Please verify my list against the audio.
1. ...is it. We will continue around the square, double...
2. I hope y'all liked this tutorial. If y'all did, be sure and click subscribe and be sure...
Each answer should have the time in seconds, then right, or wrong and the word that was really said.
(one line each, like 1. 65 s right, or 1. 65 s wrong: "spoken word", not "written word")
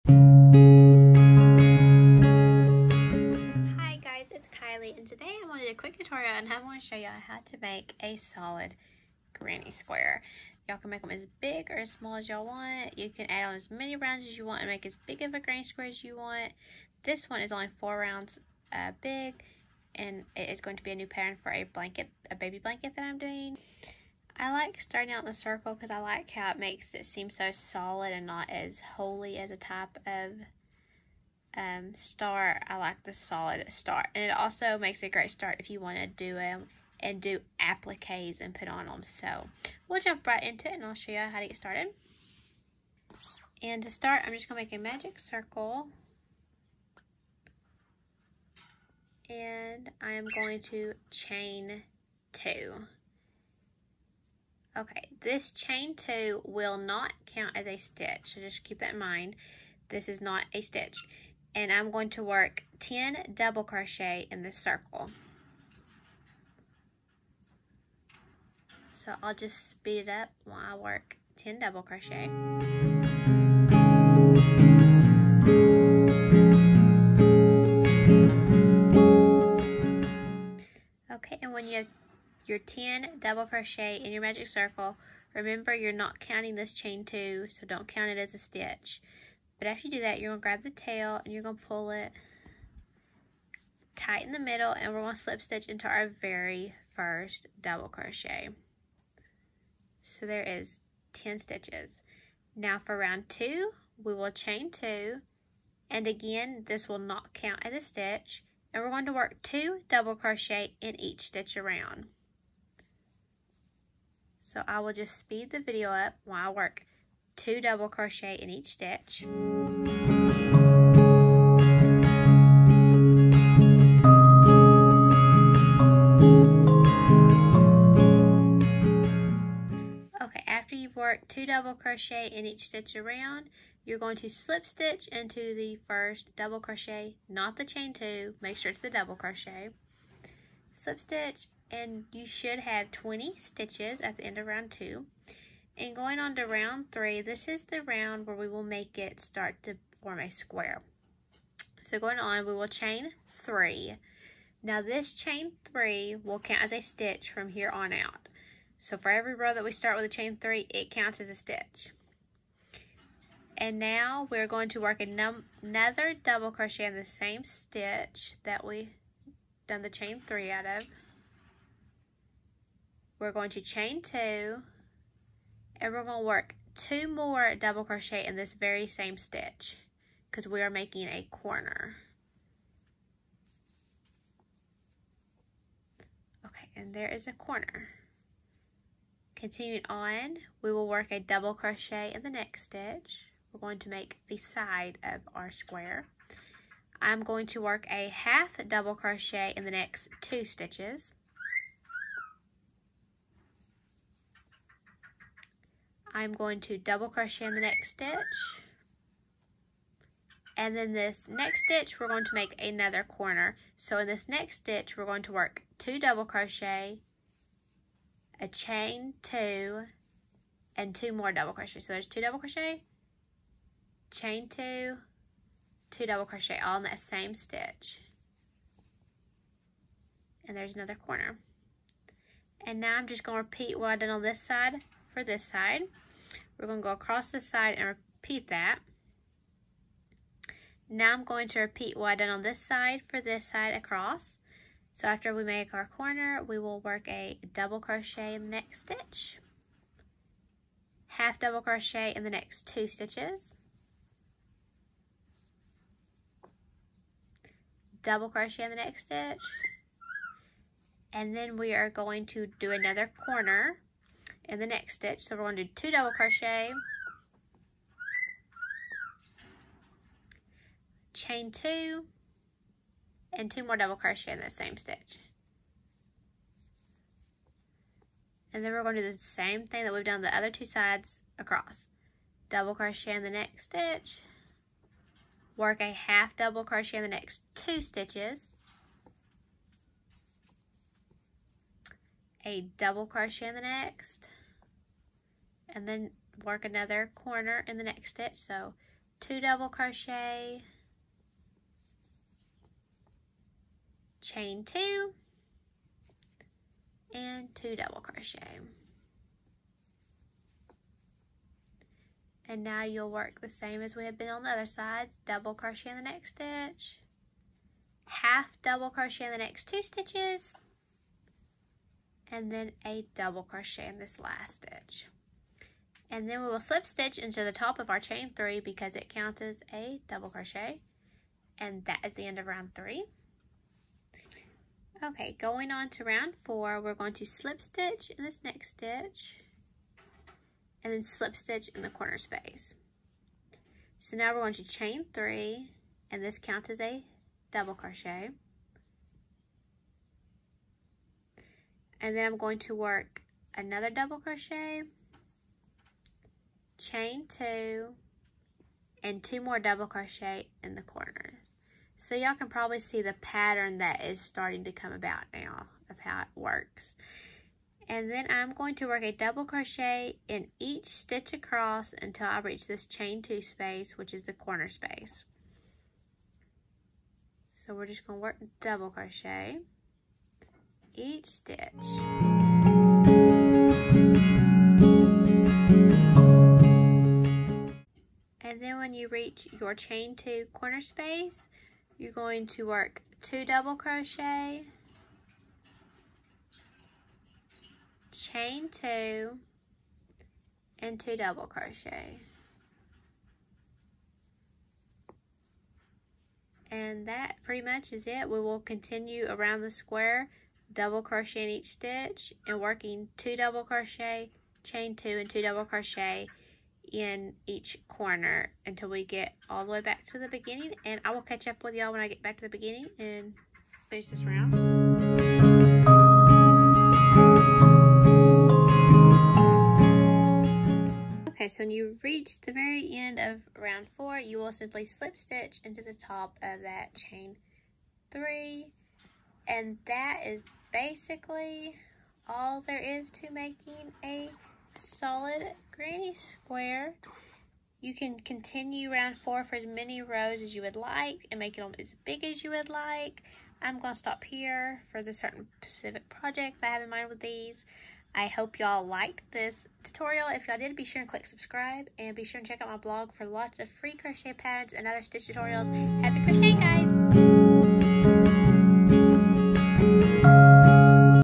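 1. 407 s right
2. 458 s right.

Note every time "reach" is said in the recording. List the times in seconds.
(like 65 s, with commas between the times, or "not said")
372 s, 389 s, 432 s.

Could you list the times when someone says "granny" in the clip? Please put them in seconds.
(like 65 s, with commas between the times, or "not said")
9 s, 15 s, 445 s.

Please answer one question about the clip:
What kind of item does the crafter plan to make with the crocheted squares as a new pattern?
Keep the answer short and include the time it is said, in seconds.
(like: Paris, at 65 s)
baby blanket, at 22 s.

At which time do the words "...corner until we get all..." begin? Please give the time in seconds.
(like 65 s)
417 s.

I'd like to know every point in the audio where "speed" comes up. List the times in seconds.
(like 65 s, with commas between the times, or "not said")
69 s, 115 s.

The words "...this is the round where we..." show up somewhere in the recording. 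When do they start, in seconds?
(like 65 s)
147 s.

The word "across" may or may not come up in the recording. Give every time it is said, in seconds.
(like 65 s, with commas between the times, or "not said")
236 s, 243 s, 281 s, 371 s.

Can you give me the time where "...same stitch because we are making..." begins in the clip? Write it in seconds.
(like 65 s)
178 s.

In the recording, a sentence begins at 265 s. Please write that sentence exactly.
So we're going to do two double crochet, chain two, and two more double crochet in that same stitch.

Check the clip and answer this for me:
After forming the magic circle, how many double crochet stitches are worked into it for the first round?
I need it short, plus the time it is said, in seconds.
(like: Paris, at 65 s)
10, at 62 s.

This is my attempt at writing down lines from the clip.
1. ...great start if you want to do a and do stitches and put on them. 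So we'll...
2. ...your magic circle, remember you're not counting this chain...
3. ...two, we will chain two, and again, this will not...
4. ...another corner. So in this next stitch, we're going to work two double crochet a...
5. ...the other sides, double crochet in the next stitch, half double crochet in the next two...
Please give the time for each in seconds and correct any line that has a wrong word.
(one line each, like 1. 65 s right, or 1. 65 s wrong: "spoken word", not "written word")
1. 35 s wrong: "appliques", not "stitches"
2. 84 s right
3. 103 s right
4. 212 s right
5. 314 s right.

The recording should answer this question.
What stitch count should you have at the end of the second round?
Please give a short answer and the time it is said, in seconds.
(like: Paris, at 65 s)
20, at 142 s.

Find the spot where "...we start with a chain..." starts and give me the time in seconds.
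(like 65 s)
159 s.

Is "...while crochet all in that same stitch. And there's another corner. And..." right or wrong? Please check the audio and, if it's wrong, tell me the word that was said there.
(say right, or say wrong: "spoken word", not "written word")
wrong: "double", not "while".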